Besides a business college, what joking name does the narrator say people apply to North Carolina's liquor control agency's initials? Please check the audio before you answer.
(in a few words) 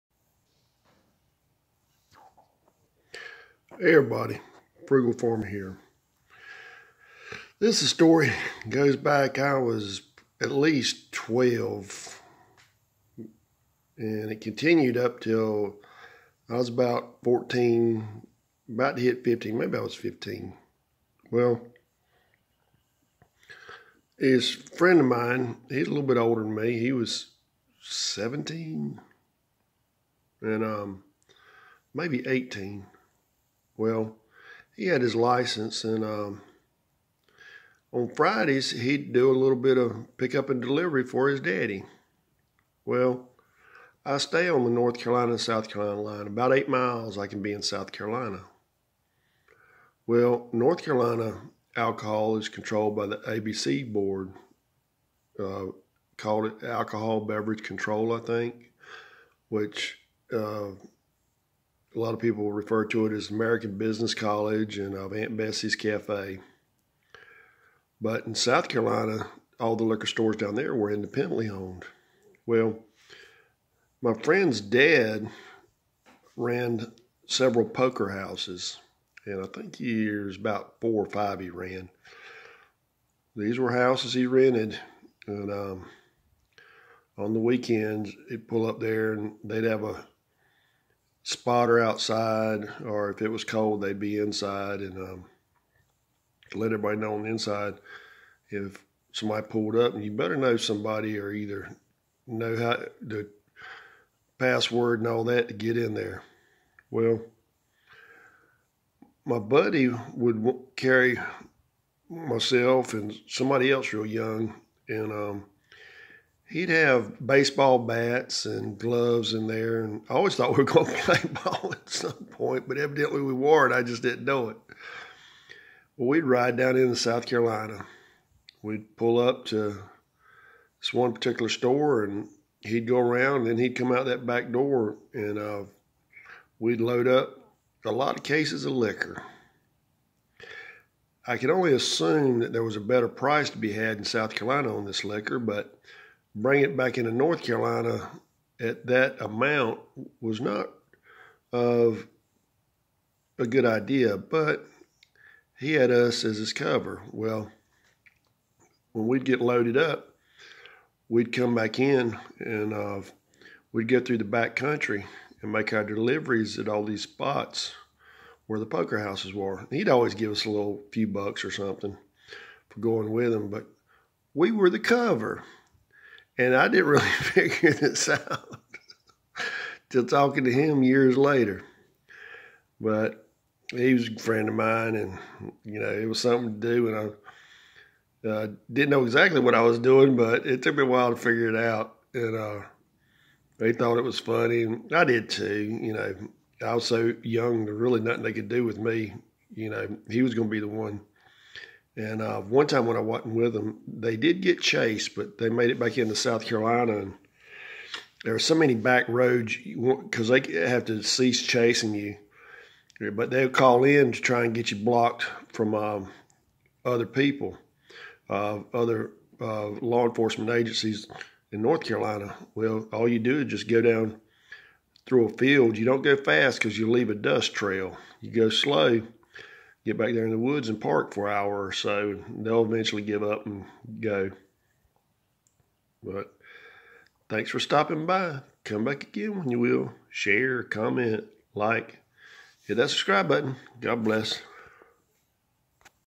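Aunt Bessie's Cafe.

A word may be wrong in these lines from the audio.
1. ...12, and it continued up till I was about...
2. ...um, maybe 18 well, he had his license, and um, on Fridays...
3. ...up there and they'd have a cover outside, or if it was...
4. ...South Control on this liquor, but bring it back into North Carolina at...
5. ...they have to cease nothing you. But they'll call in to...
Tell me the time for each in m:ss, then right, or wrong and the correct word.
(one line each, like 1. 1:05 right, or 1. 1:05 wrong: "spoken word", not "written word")
1. 0:11 right
2. 0:30 right
3. 1:28 wrong: "spotter", not "cover"
4. 2:24 wrong: "Carolina", not "Control"
5. 3:30 wrong: "chasing", not "nothing".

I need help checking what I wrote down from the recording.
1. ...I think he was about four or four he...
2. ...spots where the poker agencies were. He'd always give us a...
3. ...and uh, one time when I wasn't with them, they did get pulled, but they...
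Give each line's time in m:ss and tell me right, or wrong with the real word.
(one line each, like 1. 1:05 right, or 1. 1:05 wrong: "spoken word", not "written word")
1. 1:19 wrong: "five", not "four"
2. 2:47 wrong: "houses", not "agencies"
3. 3:21 wrong: "chased", not "pulled".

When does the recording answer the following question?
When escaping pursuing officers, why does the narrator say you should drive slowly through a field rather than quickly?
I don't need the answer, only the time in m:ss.
3:46.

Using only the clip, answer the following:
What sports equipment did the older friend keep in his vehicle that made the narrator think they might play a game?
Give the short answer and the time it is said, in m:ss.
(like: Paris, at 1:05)
baseball bats and gloves, at 1:57.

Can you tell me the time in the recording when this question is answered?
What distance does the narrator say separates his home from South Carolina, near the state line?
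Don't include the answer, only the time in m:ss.
0:46.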